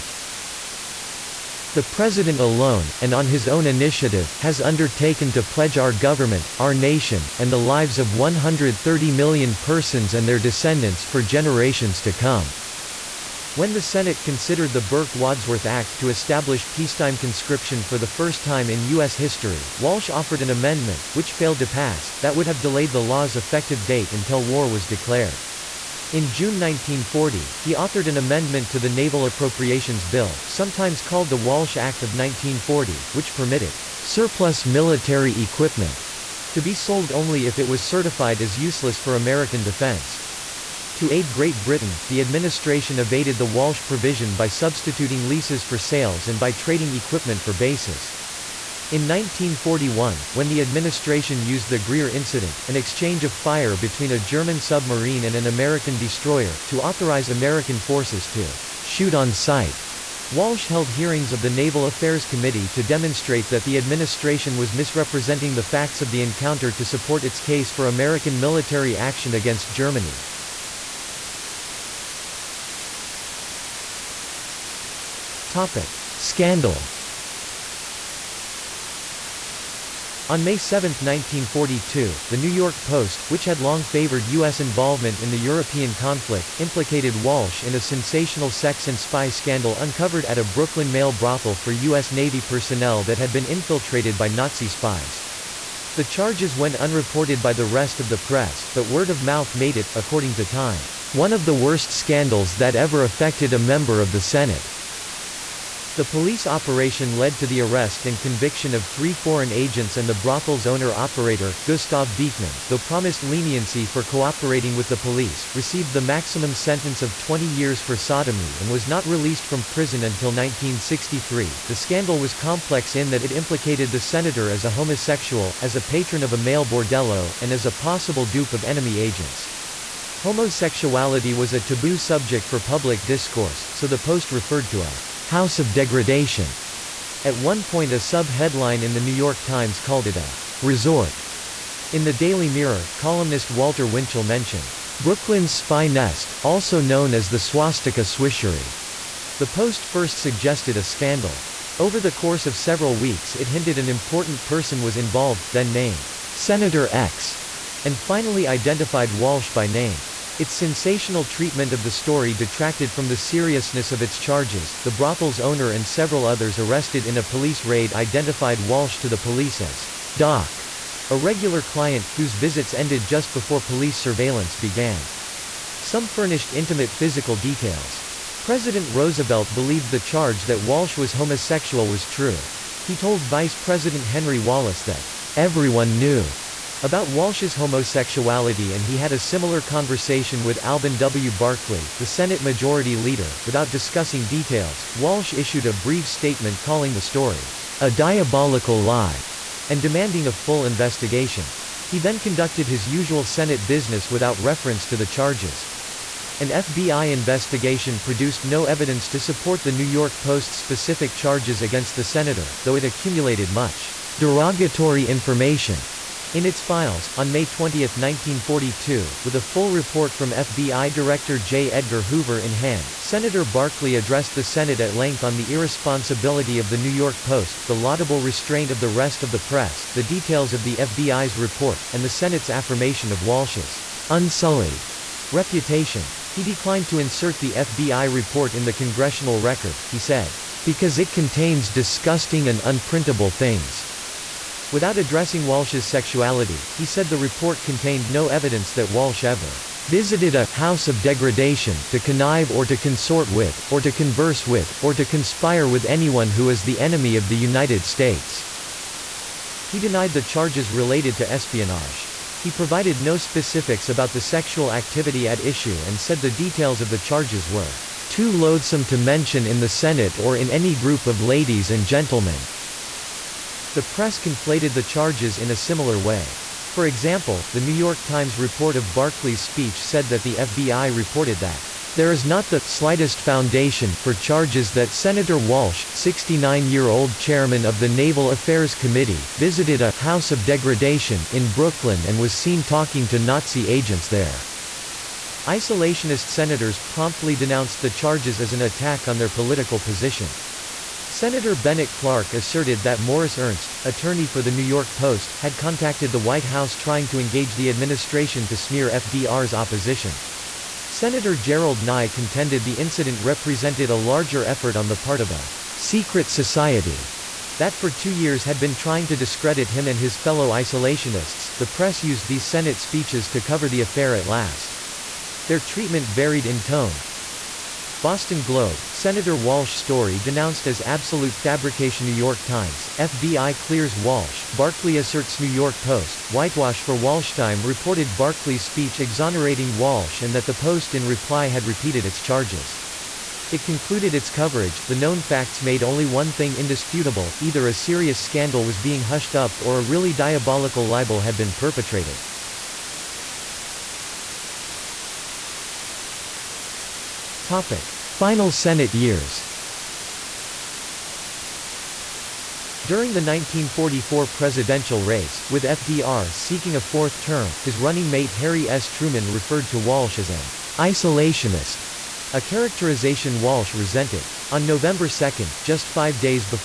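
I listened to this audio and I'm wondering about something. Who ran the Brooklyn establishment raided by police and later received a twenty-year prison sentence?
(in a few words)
Gustav Beekman.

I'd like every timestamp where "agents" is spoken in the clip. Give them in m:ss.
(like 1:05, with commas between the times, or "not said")
1:49, 2:08, 4:53.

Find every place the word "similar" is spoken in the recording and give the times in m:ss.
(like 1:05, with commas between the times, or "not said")
3:09, 4:35.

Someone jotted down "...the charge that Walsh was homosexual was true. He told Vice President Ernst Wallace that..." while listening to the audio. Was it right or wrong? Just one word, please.
wrong.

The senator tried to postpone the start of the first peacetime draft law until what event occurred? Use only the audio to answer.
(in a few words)
War was declared.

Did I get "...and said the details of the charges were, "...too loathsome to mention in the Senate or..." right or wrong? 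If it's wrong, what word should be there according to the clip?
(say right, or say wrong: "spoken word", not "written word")
right.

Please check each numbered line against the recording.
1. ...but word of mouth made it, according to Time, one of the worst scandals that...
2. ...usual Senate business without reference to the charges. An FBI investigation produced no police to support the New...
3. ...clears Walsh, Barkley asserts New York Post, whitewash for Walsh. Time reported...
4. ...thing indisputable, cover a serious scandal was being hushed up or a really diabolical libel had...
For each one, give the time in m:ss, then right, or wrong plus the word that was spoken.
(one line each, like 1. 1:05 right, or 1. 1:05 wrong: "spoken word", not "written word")
1. 1:38 right
2. 3:22 wrong: "evidence", not "police"
3. 5:33 right
4. 5:46 wrong: "either", not "cover".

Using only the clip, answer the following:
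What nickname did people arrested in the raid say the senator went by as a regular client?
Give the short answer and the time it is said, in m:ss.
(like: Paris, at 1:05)
Doc, at 2:50.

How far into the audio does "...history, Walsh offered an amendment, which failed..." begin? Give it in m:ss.
0:19.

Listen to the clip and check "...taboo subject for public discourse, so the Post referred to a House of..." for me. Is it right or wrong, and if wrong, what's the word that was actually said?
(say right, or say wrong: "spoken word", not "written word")
right.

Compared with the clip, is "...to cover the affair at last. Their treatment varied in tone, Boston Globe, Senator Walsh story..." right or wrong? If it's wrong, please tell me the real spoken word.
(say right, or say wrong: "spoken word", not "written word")
right.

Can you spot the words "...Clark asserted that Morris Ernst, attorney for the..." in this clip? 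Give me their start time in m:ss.
5:01.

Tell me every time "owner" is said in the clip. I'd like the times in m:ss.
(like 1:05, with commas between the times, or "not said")
1:50, 2:45.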